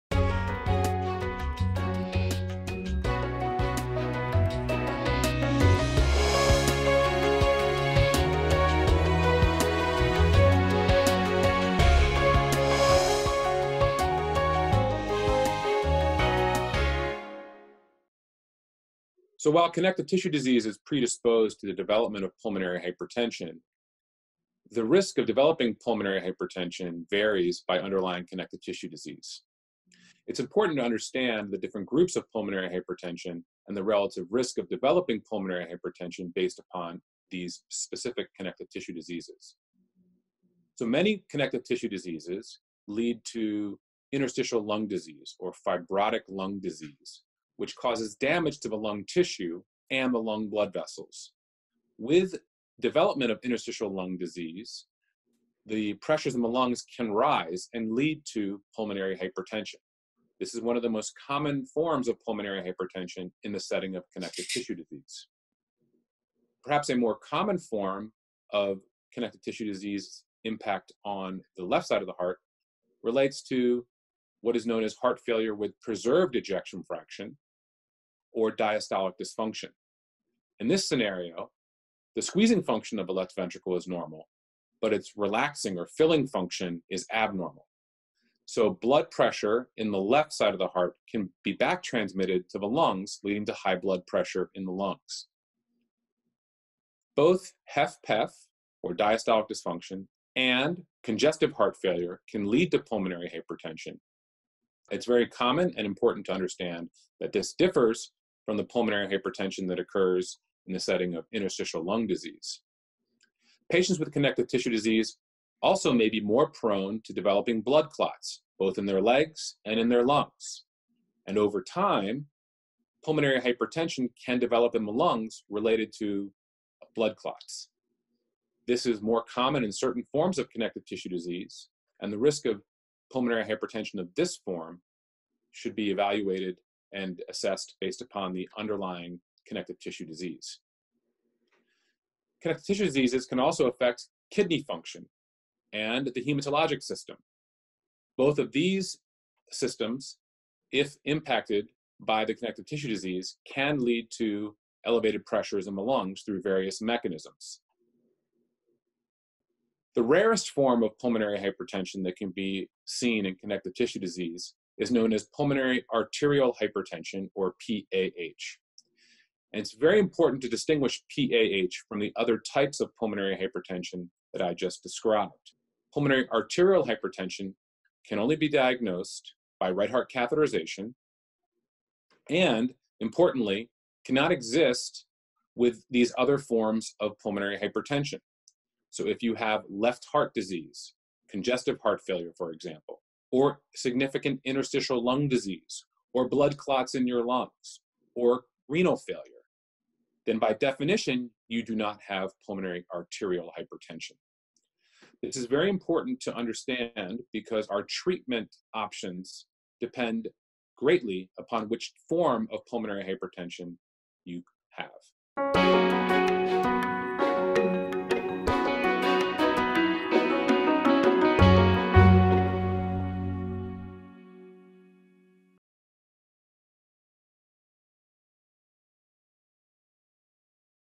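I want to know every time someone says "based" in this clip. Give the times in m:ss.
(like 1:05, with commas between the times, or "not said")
0:36, 2:17.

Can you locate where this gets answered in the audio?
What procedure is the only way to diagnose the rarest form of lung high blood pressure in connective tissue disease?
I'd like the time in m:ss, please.
2:59.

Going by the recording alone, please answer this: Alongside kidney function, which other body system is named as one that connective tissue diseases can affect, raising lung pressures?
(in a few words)
hematologic system.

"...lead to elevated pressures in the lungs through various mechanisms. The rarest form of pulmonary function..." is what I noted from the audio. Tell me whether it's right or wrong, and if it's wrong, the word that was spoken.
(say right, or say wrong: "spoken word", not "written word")
wrong: "hypertension", not "function".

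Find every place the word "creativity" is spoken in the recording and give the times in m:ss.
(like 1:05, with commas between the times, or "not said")
not said.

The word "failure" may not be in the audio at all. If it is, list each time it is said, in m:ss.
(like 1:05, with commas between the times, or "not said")
1:15, 1:41, 3:12, 3:18.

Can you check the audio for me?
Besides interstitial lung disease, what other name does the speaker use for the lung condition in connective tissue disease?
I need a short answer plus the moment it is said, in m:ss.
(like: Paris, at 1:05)
fibrotic lung disease, at 0:45.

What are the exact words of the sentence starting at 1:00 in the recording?
This is one of the most common forms of pulmonary hypertension in the setting of connective tissue disease.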